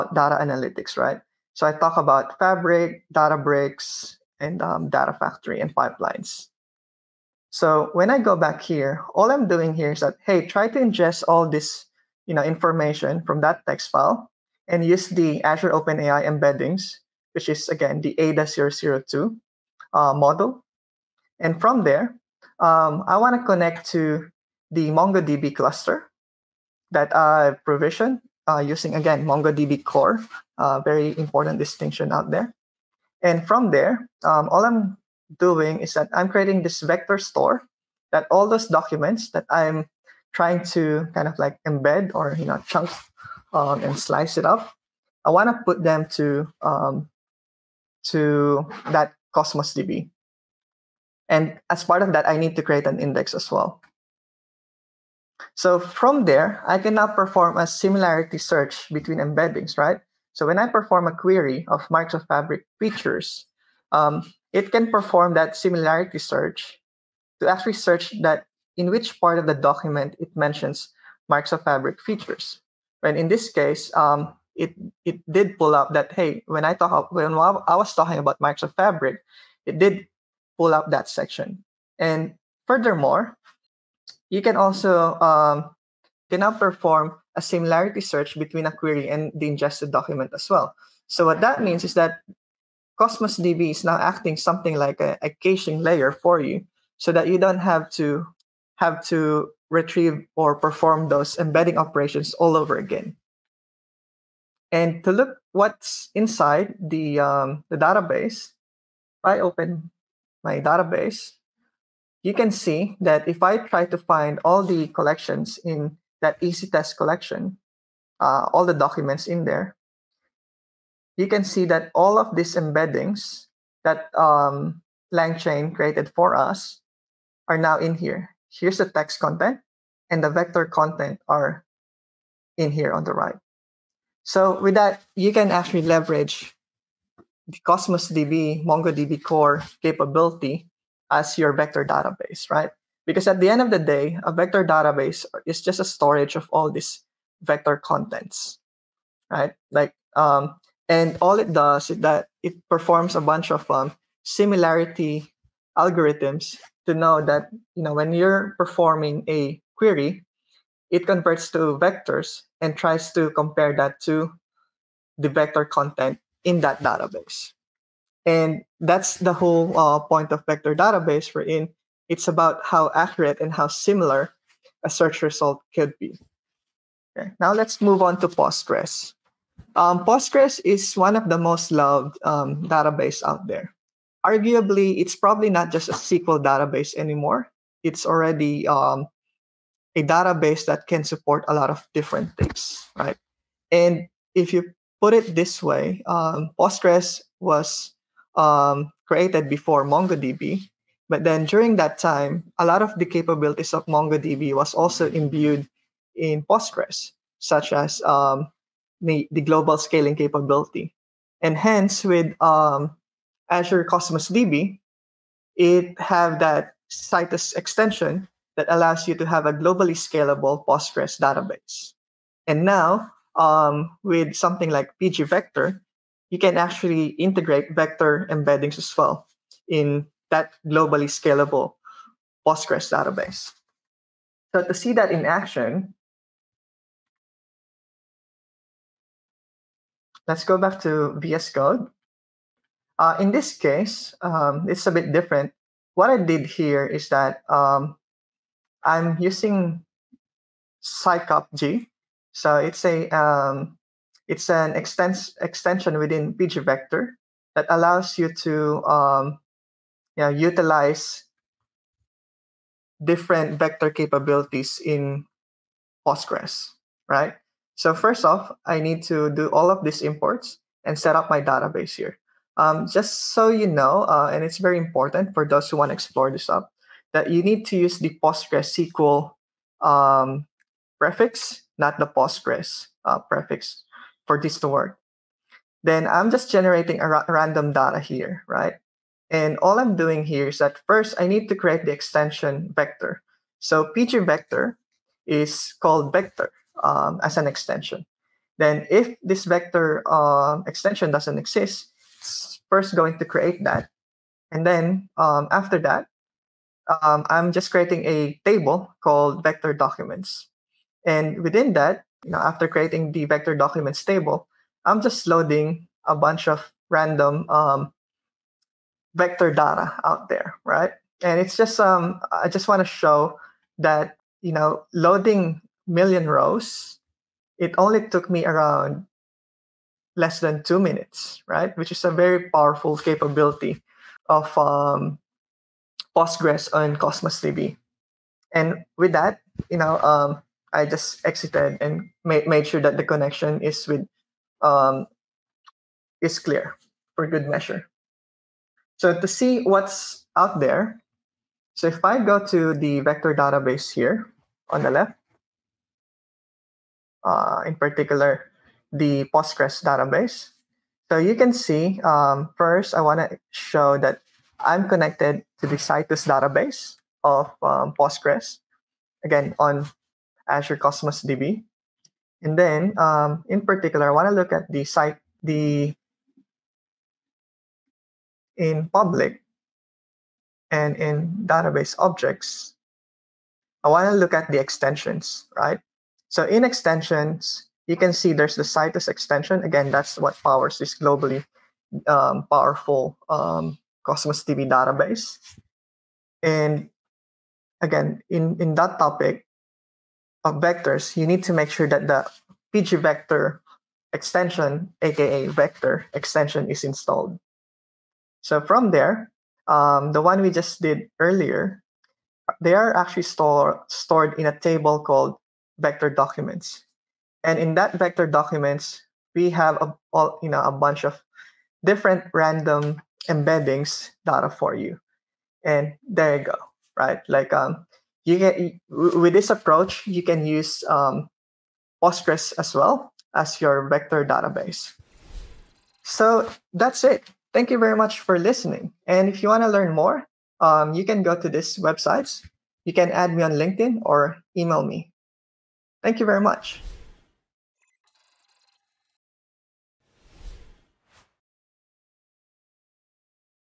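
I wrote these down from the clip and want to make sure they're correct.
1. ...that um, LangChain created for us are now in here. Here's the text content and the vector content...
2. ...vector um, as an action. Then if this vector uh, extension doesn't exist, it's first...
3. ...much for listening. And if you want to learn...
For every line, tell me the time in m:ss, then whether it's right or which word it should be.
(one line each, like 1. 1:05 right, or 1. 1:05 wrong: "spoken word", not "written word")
1. 2:03 right
2. 4:56 wrong: "extension", not "action"
3. 7:17 right.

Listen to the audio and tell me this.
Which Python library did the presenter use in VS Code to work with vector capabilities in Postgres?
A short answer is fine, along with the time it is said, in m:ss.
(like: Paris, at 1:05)
psycopg, at 4:10.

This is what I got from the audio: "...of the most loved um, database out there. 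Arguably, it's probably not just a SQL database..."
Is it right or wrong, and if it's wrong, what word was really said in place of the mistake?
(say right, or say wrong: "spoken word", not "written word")
right.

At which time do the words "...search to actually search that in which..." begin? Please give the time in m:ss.
1:06.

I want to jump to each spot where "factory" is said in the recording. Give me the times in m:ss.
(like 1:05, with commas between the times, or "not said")
0:05.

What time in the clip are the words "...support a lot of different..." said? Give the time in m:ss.
3:11.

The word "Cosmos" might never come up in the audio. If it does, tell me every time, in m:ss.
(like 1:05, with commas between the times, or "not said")
0:49, 1:32, 2:17, 3:33, 5:36, 6:10, 6:34.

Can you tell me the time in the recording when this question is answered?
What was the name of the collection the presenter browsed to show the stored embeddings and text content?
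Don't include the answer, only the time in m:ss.
1:56.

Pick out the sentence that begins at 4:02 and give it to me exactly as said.
Uh, in this case, um, it's a bit different.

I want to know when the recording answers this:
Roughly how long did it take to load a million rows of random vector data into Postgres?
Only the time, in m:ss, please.
5:30.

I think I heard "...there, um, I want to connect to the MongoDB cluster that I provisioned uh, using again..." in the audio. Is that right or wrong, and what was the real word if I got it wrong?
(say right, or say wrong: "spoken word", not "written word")
right.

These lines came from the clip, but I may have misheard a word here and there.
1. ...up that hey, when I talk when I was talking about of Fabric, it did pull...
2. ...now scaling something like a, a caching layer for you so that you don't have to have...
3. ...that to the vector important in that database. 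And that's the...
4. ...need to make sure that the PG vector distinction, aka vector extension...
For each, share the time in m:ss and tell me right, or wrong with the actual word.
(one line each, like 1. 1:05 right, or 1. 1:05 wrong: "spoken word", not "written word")
1. 1:15 right
2. 1:33 wrong: "acting", not "scaling"
3. 2:43 wrong: "content", not "important"
4. 6:41 wrong: "extension", not "distinction".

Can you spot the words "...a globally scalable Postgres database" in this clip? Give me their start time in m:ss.
3:39.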